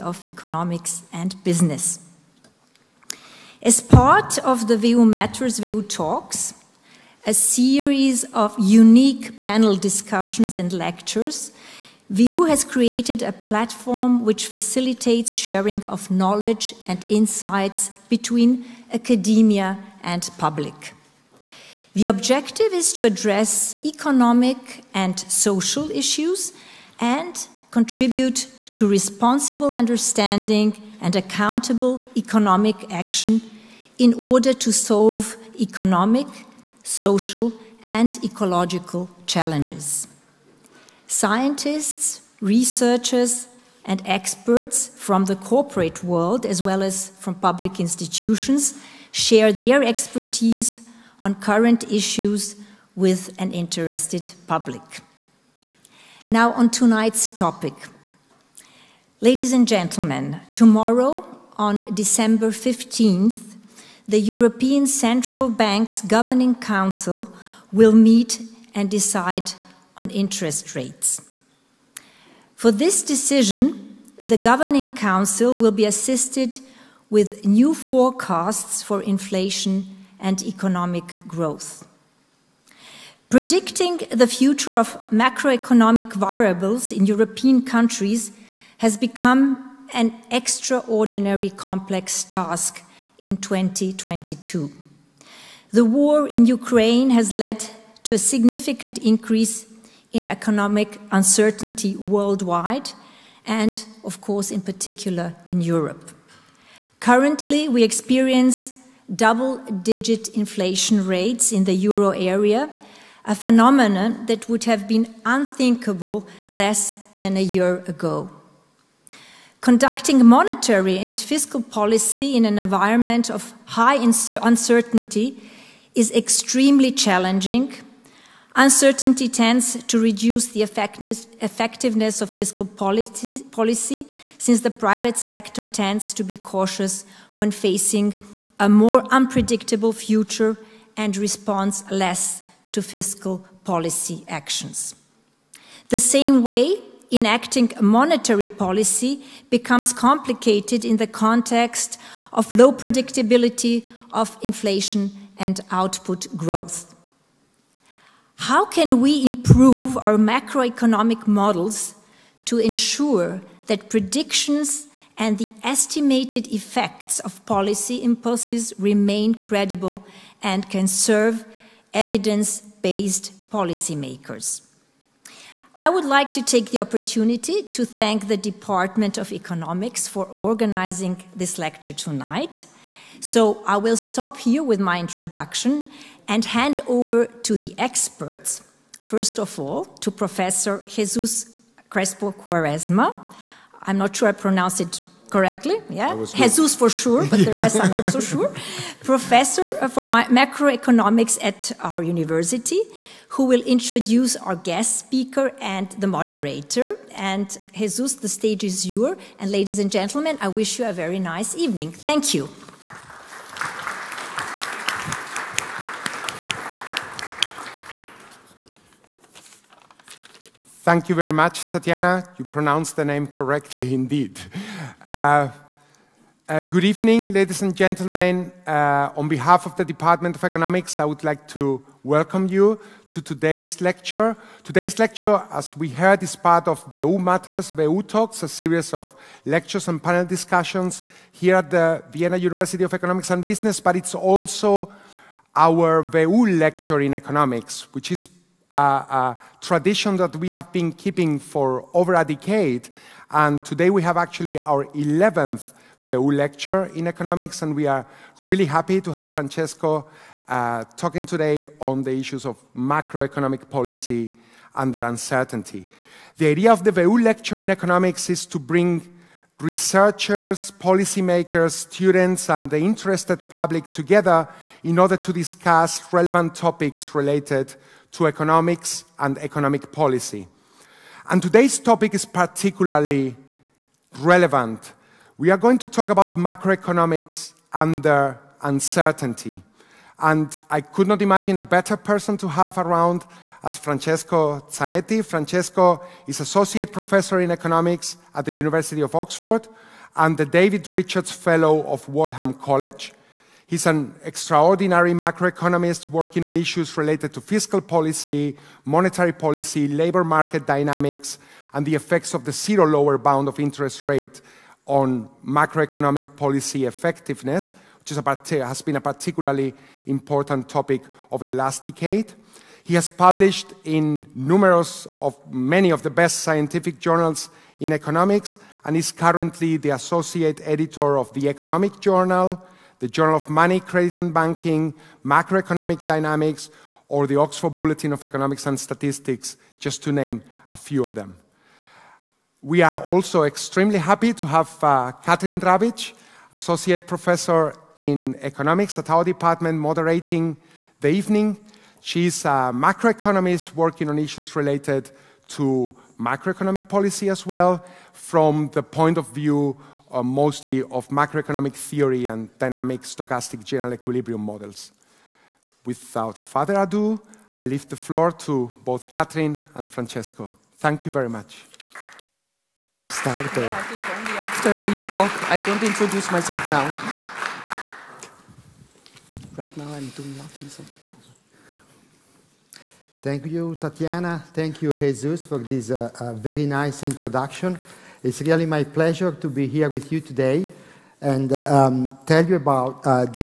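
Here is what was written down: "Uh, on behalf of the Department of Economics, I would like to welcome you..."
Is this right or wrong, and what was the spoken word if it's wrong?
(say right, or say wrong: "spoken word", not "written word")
right.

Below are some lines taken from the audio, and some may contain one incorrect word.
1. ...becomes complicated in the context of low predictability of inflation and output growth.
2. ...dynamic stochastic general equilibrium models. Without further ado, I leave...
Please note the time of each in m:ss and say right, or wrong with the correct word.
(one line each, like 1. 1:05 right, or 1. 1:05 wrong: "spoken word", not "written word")
1. 2:29 right
2. 6:02 right.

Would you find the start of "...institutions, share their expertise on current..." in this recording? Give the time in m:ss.
0:47.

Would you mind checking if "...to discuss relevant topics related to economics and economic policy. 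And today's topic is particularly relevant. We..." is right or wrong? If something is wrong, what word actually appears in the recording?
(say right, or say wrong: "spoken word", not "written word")
right.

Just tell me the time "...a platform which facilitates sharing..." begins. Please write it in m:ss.
0:13.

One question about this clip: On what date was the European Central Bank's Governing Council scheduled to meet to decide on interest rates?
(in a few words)
December 15th.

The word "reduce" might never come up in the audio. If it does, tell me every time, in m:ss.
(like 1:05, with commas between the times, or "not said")
2:09.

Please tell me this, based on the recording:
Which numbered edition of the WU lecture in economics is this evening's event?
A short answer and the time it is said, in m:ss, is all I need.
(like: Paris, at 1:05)
11th, at 4:14.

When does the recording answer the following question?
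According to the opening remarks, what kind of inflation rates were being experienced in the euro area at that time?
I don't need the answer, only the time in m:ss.
1:49.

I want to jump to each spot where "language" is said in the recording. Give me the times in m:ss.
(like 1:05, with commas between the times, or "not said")
not said.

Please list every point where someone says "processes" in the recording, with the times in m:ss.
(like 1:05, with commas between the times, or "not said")
not said.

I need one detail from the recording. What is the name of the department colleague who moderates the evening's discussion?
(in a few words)
Katrin Rabitsch.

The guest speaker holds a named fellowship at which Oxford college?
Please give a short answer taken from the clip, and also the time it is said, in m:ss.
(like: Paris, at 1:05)
Wadham College, at 5:02.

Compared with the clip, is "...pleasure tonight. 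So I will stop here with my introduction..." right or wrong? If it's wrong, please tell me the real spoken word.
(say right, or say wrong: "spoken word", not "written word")
wrong: "lecture", not "pleasure".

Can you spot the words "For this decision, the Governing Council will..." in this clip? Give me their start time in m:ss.
1:12.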